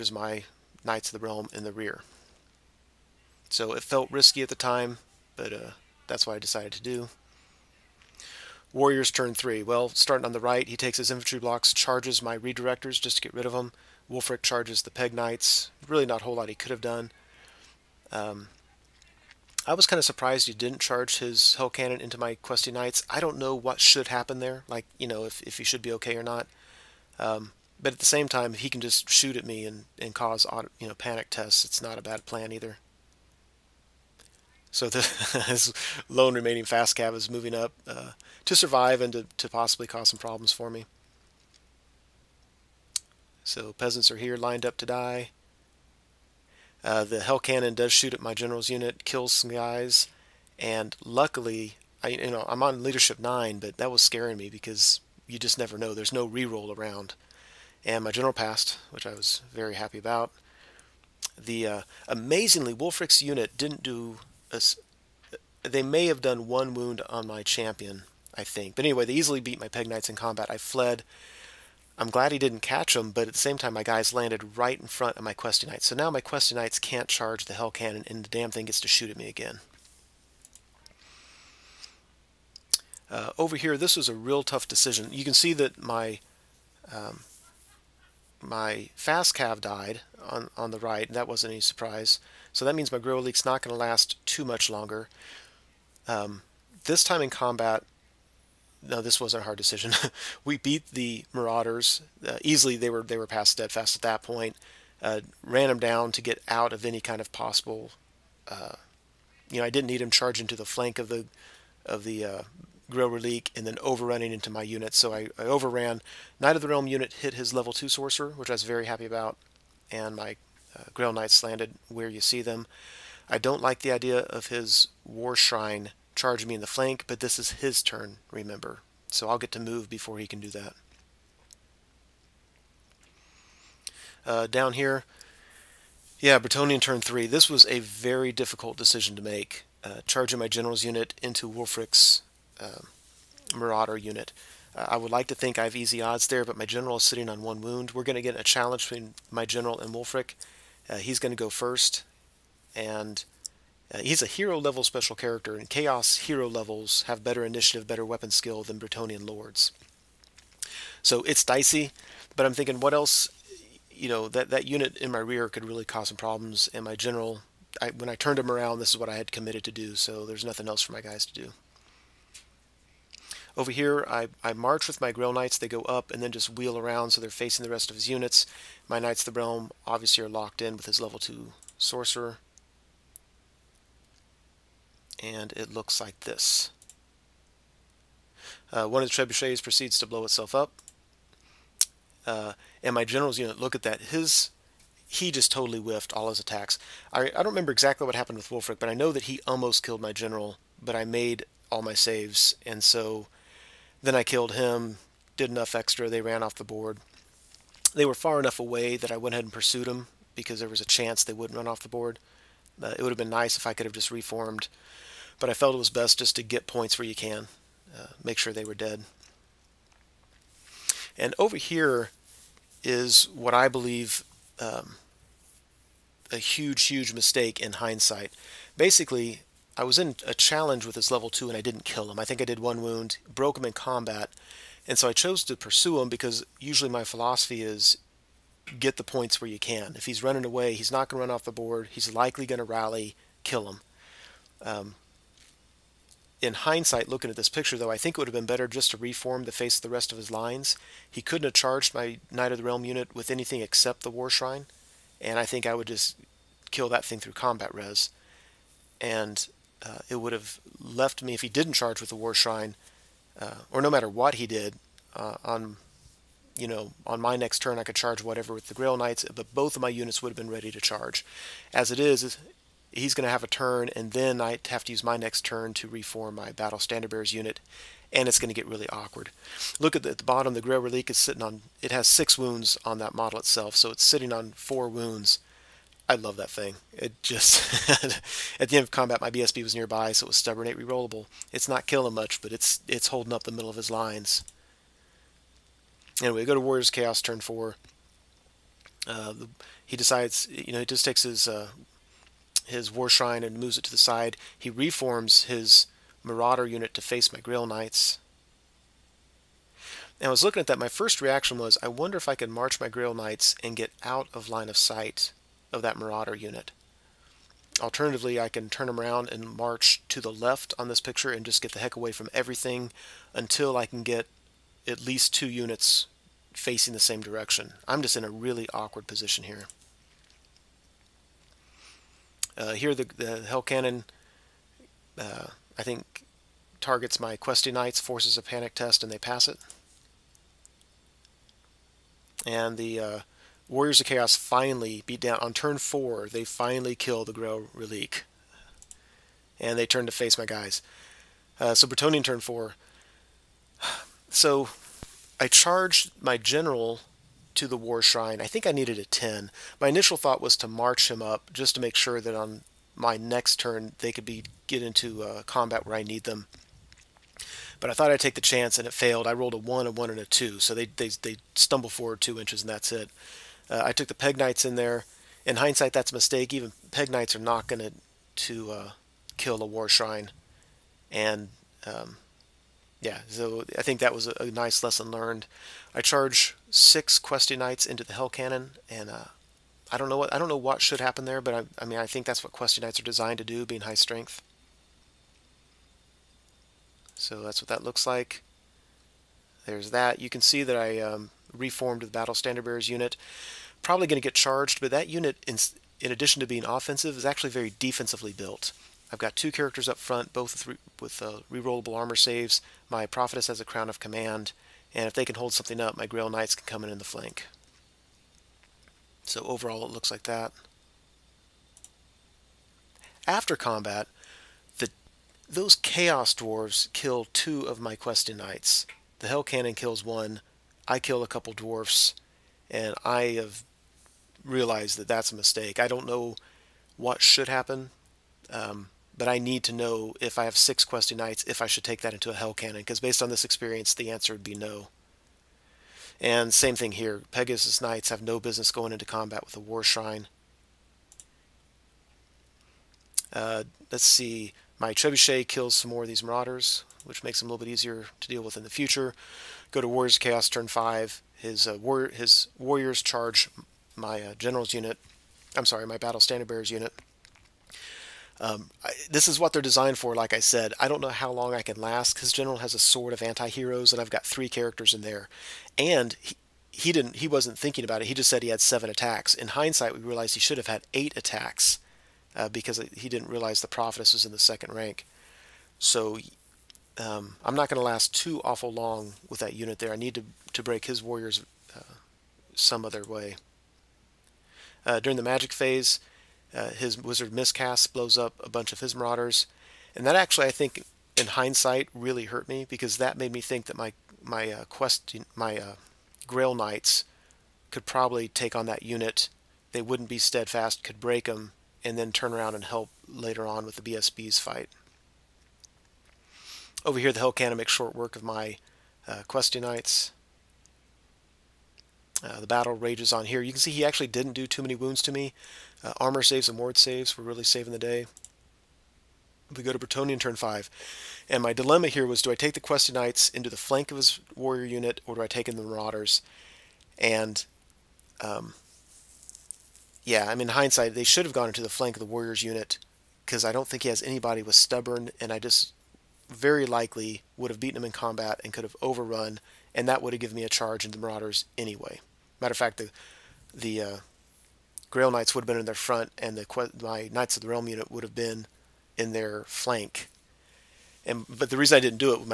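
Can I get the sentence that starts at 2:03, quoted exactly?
I don't like the idea of his War Shrine charge me in the flank, but this is his turn, remember.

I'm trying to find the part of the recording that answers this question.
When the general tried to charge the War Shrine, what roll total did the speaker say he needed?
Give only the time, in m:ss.
5:58.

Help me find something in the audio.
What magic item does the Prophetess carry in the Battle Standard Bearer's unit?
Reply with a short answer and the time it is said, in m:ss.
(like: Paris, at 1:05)
Crown of Command, at 6:53.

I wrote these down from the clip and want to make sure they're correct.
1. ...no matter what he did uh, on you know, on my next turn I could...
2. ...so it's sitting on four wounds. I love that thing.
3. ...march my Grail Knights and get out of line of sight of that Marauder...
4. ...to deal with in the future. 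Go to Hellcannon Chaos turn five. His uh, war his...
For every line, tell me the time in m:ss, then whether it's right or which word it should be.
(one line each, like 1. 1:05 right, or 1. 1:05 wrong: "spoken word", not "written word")
1. 4:23 right
2. 4:43 right
3. 5:12 right
4. 7:38 wrong: "Warriors", not "Hellcannon".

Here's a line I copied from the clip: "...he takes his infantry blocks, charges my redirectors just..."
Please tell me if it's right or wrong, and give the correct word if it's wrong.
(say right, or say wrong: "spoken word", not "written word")
right.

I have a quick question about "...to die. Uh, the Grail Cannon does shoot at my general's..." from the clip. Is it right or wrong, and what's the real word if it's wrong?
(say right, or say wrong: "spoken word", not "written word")
wrong: "Hell", not "Grail".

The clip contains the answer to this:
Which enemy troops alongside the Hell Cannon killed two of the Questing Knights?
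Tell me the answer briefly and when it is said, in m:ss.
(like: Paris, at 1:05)
Chaos Dwarves, at 7:05.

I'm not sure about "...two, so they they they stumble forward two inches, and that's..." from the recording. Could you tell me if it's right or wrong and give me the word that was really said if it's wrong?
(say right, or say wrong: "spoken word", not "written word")
right.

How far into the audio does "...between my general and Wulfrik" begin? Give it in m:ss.
2:28.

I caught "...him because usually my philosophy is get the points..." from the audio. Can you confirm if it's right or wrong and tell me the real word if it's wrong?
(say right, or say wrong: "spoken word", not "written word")
right.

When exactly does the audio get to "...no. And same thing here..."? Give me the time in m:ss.
7:24.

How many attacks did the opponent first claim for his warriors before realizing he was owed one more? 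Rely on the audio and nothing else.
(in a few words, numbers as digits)
7.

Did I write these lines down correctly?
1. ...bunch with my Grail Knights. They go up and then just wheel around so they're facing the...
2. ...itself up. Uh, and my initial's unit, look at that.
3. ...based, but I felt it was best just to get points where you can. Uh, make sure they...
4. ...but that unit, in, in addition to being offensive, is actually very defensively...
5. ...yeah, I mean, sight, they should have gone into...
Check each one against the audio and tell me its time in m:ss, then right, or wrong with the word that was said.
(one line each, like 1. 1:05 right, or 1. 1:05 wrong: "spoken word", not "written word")
1. 2:54 wrong: "march", not "bunch"
2. 3:10 wrong: "general", not "initial"
3. 3:34 wrong: "reformed", not "based"
4. 6:44 right
5. 9:00 wrong: "hindsight", not "sight".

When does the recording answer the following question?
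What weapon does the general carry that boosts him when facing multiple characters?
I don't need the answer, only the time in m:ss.
7:52.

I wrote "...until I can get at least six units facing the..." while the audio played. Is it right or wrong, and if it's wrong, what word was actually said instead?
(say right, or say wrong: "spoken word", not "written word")
wrong: "two", not "six".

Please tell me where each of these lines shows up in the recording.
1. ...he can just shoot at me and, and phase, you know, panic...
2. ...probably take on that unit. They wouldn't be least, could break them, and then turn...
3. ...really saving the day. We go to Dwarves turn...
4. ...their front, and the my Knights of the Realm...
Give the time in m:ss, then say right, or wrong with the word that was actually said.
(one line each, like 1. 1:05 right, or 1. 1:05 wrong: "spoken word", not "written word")
1. 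0:28 wrong: "cause", not "phase"
2. 8:27 wrong: "steadfast", not "least"
3. 8:47 wrong: "Bretonnian", not "Dwarves"
4. 9:15 right.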